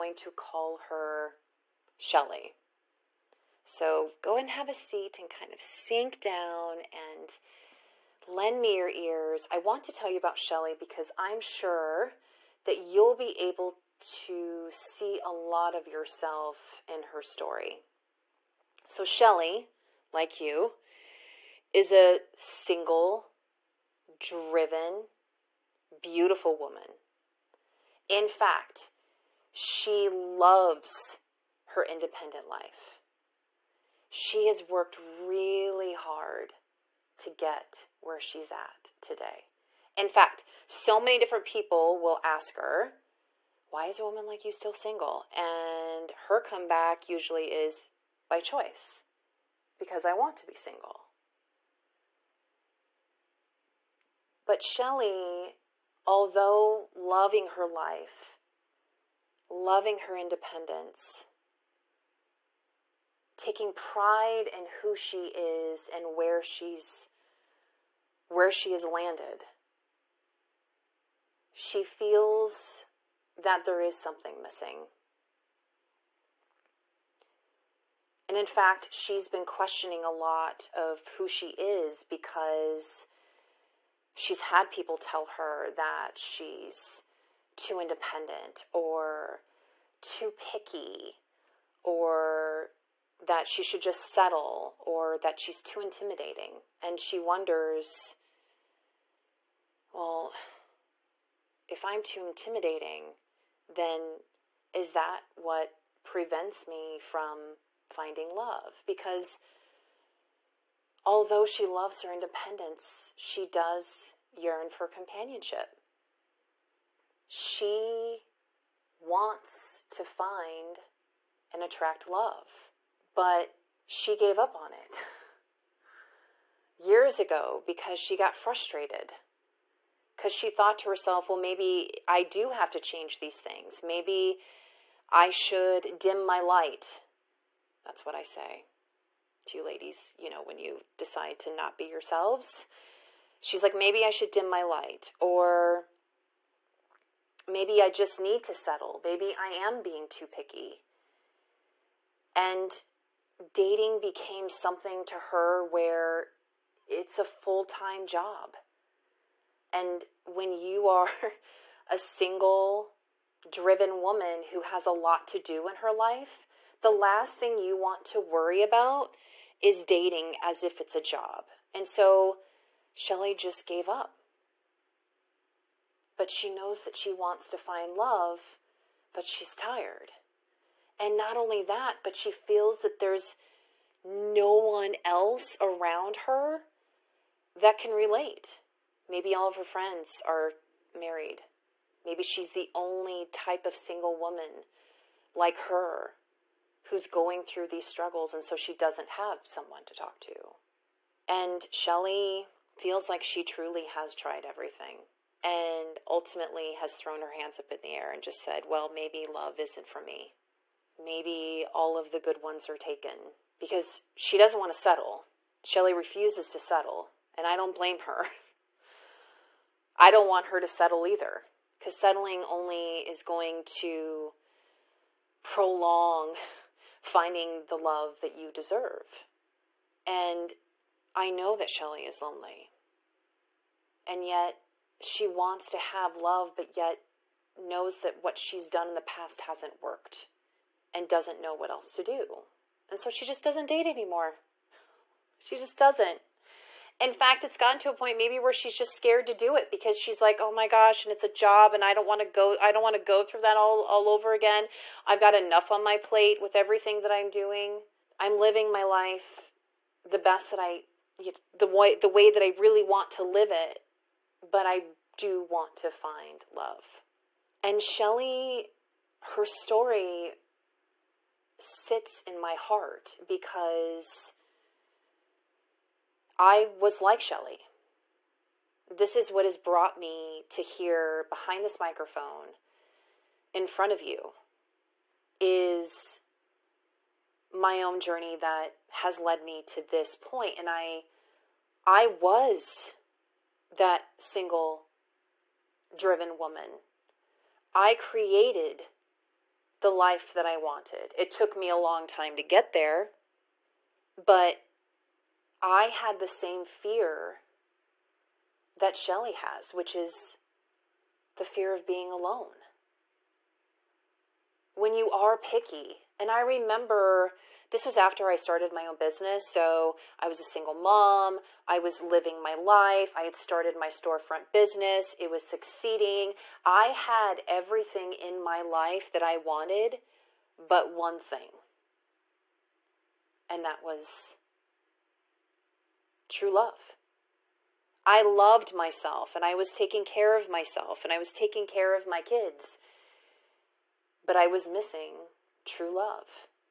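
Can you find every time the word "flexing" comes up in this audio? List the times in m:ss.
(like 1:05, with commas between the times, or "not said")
not said.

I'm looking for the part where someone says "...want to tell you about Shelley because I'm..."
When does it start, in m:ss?
0:09.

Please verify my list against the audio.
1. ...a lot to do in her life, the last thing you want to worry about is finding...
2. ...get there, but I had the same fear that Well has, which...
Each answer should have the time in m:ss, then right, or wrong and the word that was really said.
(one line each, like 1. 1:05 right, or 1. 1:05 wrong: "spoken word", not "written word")
1. 2:44 wrong: "dating", not "finding"
2. 5:02 wrong: "Shelley", not "Well".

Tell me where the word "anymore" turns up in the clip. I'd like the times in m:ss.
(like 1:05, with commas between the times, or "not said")
4:03.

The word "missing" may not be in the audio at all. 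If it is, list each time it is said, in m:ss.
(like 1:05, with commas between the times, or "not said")
1:14, 5:44.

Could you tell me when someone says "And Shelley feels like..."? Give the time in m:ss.
3:21.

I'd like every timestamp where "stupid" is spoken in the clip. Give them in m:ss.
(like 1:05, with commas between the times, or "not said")
not said.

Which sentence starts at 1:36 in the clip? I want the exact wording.
And she wonders, well, if I'm too intimidating, then is that what prevents me from finding love?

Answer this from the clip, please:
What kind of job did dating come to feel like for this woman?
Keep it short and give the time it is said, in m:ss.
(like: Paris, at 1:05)
A full time job, at 2:37.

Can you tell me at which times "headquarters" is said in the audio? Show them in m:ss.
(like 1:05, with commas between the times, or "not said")
not said.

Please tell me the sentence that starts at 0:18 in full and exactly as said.
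So, Shelley, like you, is a single, driven, beautiful woman.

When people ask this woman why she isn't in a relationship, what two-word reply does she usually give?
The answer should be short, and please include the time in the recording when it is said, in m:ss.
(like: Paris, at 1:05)
By choice, at 0:48.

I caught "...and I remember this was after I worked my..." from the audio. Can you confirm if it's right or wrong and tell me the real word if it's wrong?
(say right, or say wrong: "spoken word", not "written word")
wrong: "started", not "worked".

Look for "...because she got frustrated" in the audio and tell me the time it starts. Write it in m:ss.
2:07.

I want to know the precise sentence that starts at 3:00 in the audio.
And not only that, but she feels that there's no one else around her that can relate.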